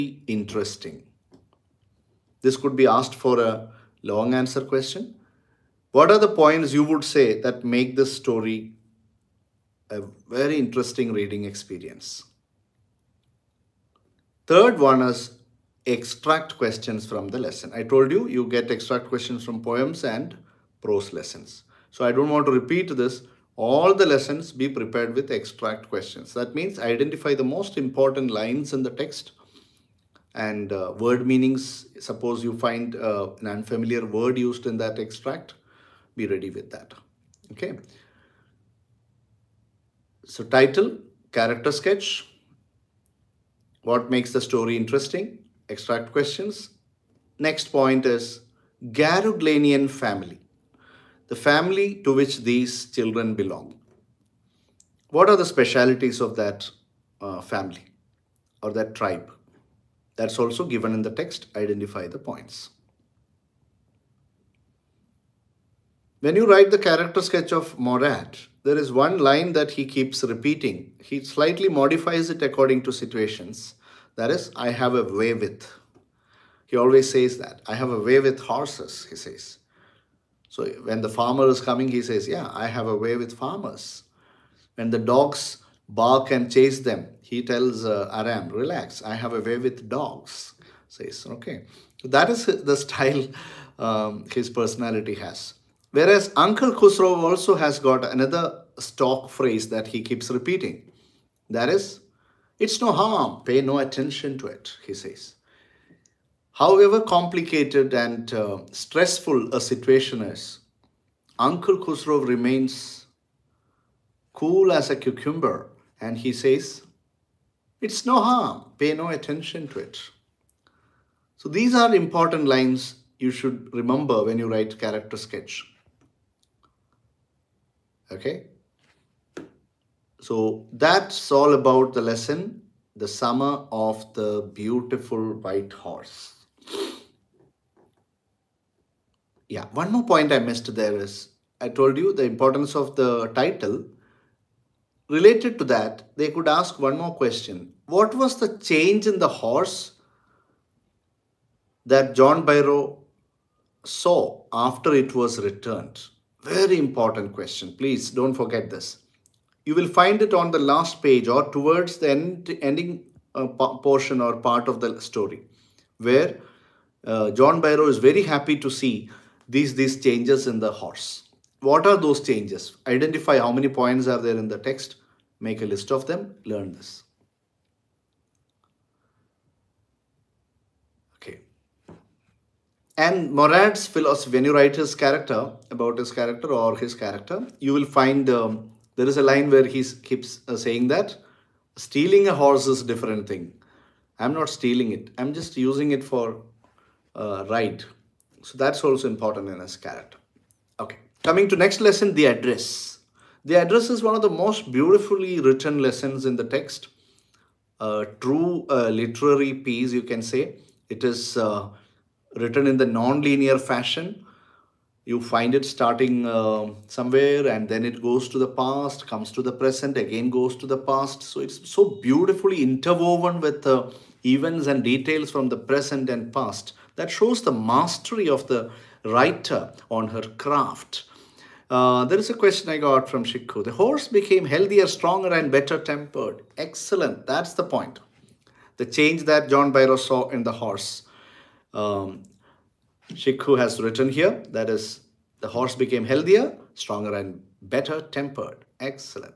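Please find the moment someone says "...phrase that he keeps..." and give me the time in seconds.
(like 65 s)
99 s.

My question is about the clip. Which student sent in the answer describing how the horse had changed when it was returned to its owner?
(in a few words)
Shikku.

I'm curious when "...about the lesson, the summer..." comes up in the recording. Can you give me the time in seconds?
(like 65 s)
131 s.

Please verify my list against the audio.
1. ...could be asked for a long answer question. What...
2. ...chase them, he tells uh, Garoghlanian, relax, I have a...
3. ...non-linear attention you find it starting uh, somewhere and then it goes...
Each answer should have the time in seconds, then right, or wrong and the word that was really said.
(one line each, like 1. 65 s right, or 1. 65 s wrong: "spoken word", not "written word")
1. 2 s right
2. 86 s wrong: "Aram", not "Garoghlanian"
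3. 212 s wrong: "fashion", not "attention".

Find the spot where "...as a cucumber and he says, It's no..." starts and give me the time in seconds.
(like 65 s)
114 s.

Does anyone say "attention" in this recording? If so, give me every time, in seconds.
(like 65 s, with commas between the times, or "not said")
103 s, 119 s.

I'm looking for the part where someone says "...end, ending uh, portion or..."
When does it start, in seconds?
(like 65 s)
162 s.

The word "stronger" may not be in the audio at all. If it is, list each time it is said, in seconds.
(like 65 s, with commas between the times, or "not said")
234 s, 246 s.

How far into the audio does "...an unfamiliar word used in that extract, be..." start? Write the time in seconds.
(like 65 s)
33 s.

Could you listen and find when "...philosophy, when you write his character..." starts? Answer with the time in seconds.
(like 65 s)
183 s.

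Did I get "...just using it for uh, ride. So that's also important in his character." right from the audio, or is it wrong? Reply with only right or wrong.
right.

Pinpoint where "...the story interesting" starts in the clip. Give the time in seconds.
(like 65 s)
44 s.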